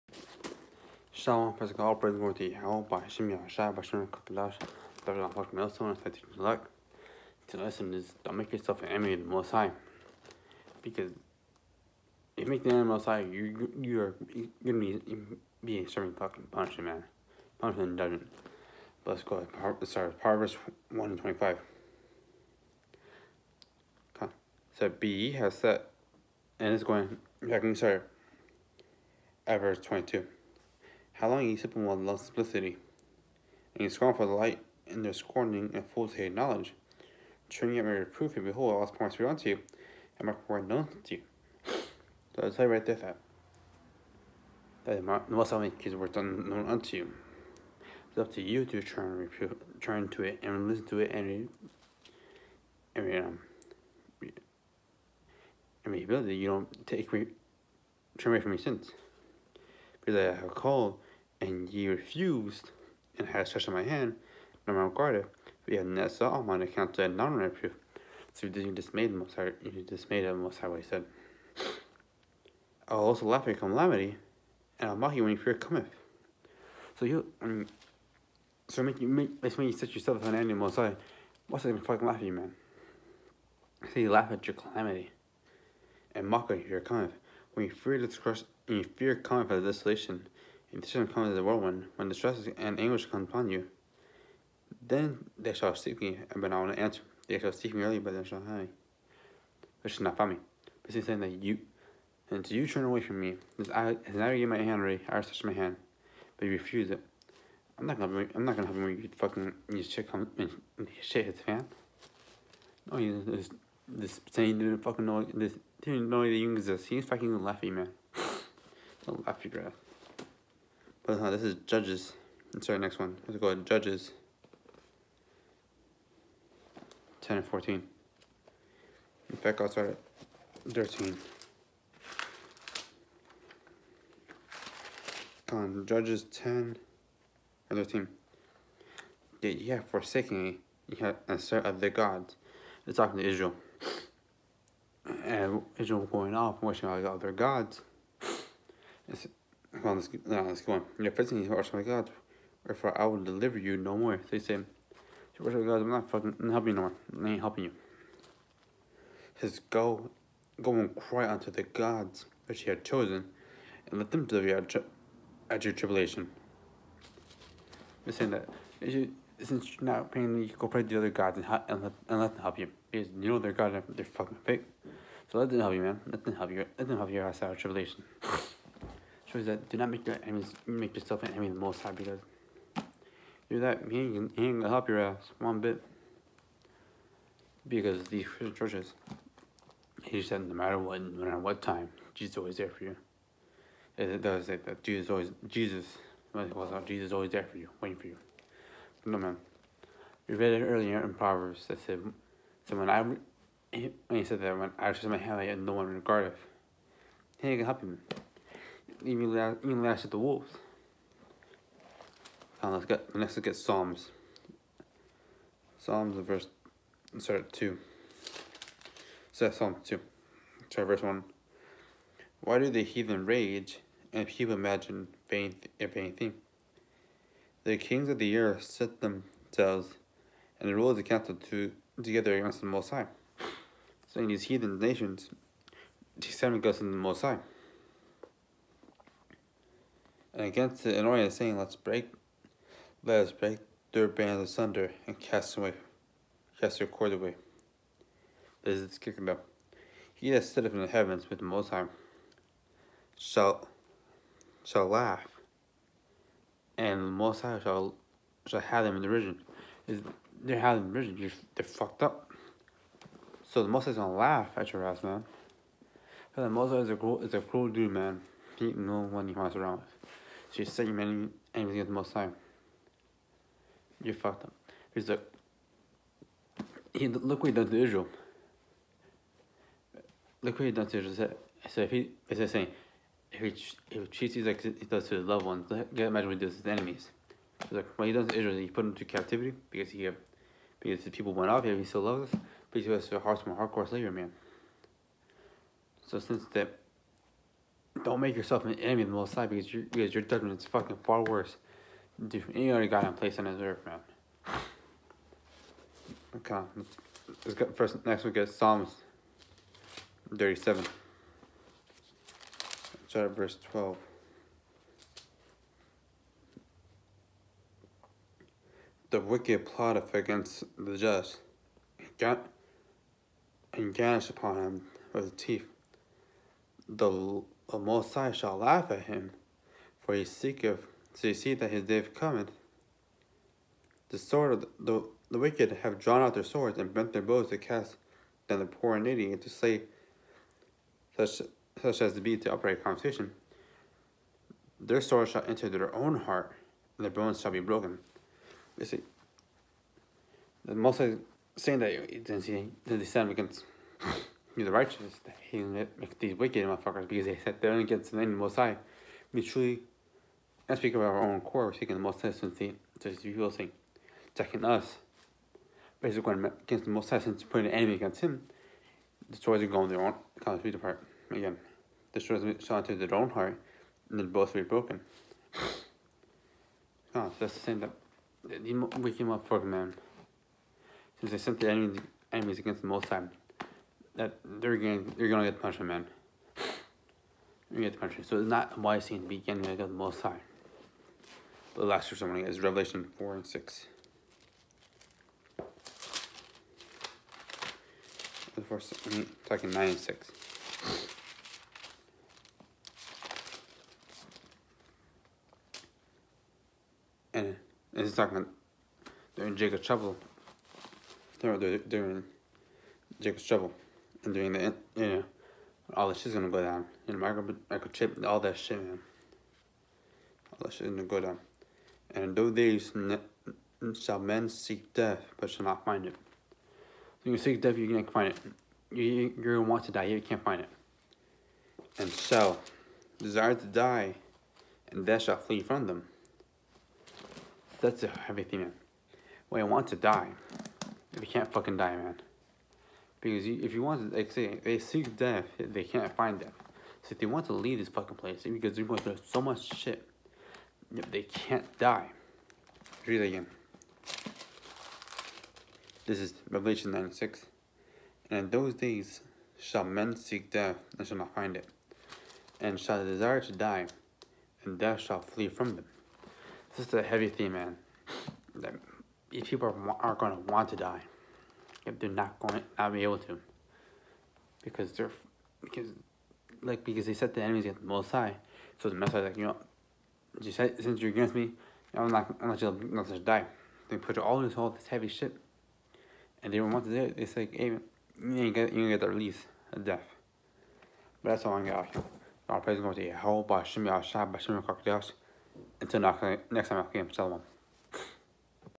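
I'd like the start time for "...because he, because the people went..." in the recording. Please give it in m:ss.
4:49.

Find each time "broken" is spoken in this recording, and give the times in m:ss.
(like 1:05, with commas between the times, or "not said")
5:47, 6:14.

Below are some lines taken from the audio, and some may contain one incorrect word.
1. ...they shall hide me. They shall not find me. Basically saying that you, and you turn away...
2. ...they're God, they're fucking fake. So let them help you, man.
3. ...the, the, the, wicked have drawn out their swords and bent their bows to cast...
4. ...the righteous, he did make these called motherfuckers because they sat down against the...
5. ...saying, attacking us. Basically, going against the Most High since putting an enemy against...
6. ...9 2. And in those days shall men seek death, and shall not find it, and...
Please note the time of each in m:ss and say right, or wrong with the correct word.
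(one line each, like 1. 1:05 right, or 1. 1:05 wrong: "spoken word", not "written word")
1. 1:38 right
2. 2:53 right
3. 5:34 right
4. 5:54 wrong: "wicked", not "called"
5. 6:03 right
6. 7:36 wrong: "6", not "2".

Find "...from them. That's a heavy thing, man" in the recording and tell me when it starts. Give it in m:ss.
7:15.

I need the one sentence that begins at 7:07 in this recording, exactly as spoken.
So you seek death, you can't find it.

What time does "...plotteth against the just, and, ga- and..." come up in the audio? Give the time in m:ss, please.
5:19.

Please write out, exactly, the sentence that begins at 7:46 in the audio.
This is a heavy theme, man.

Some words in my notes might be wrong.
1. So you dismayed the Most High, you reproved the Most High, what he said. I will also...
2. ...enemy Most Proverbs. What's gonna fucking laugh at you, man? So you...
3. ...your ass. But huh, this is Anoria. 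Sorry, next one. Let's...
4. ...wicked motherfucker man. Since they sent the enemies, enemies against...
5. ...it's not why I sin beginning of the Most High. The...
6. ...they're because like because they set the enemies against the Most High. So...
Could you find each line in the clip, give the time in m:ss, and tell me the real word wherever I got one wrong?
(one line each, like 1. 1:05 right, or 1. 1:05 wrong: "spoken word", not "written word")
1. 1:08 wrong: "dismayed", not "reproved"
2. 1:20 wrong: "High", not "Proverbs"
3. 1:59 wrong: "Judges", not "Anoria"
4. 6:18 right
5. 6:28 right
6. 7:54 right.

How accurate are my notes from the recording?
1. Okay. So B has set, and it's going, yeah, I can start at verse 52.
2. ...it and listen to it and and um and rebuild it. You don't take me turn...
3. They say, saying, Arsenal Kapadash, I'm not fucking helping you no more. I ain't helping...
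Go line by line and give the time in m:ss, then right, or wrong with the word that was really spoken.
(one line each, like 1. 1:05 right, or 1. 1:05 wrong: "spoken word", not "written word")
1. 0:24 wrong: "22", not "52"
2. 0:50 right
3. 2:34 wrong: "God", not "Kapadash".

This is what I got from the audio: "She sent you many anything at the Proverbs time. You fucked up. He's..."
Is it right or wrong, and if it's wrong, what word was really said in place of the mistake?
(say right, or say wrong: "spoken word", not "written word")
wrong: "Most", not "Proverbs".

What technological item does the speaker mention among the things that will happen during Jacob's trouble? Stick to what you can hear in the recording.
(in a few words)
microchip.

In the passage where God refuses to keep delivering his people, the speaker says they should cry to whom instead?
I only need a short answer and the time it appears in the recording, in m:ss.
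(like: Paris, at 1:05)
the gods which you have chosen, at 2:41.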